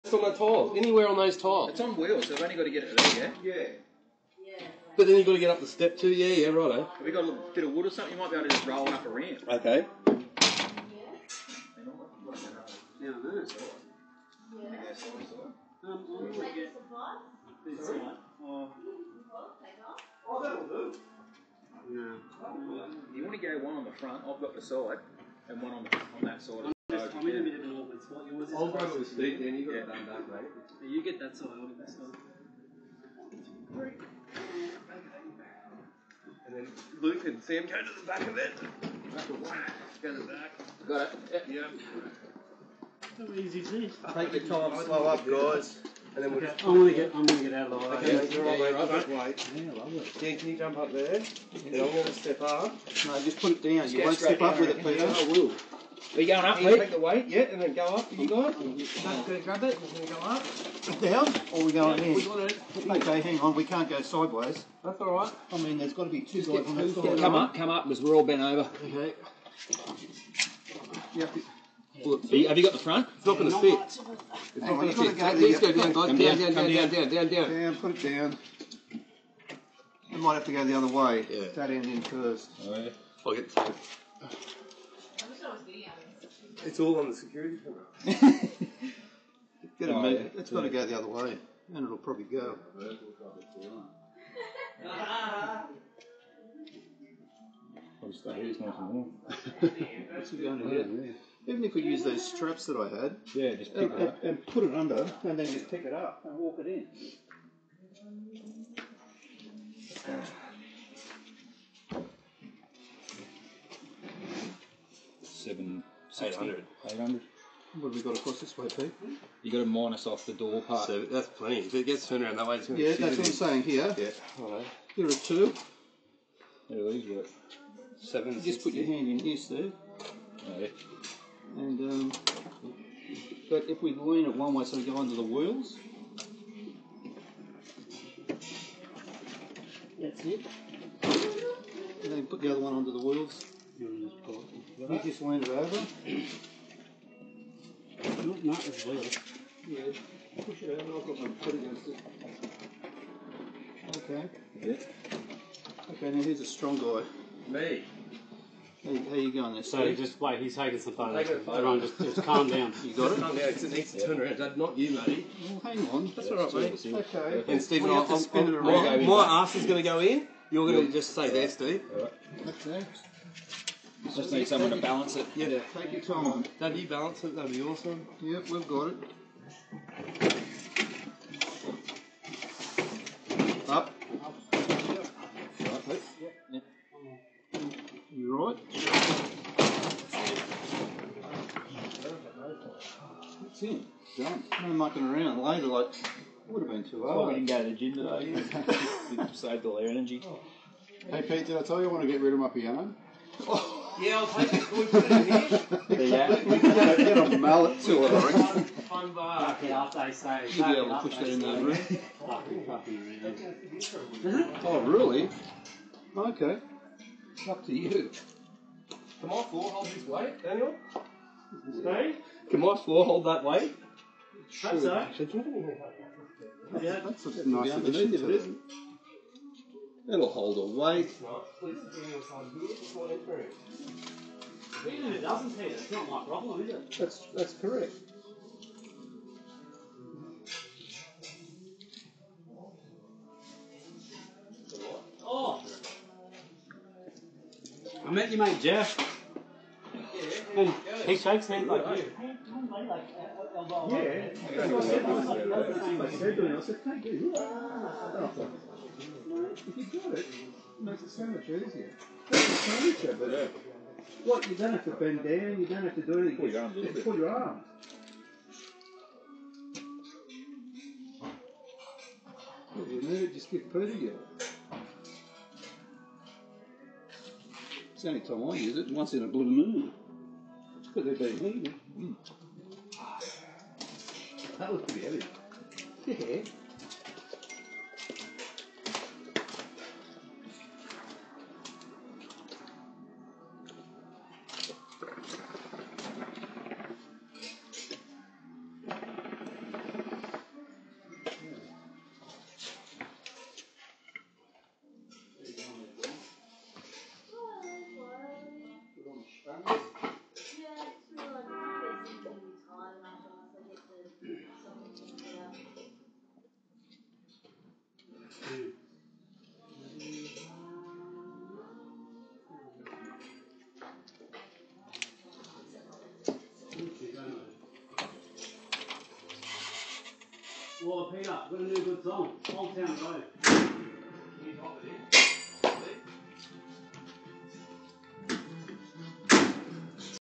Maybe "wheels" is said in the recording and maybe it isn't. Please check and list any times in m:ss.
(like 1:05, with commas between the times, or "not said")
0:01, 2:15, 2:23.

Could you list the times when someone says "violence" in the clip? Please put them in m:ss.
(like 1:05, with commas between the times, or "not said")
not said.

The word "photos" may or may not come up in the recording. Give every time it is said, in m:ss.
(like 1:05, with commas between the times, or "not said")
2:40.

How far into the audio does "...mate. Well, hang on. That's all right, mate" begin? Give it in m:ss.
2:44.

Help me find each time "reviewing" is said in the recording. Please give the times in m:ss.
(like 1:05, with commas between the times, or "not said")
not said.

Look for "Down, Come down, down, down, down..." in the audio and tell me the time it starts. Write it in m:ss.
1:15.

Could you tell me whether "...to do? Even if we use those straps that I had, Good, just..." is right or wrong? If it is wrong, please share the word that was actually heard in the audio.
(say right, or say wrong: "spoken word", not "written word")
wrong: "Yeah", not "Good".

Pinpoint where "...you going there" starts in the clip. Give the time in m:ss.
2:39.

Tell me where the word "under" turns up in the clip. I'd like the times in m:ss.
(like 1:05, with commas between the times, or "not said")
1:44, 2:14, 2:22.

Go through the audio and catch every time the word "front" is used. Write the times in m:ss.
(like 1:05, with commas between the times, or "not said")
0:23, 1:12.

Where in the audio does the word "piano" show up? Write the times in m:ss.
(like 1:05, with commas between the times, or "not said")
3:22.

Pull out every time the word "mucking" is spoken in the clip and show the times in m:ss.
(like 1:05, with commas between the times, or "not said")
3:14.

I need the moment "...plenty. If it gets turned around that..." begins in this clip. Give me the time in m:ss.
2:01.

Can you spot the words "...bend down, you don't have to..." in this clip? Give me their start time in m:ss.
4:24.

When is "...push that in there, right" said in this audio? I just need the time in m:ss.
3:31.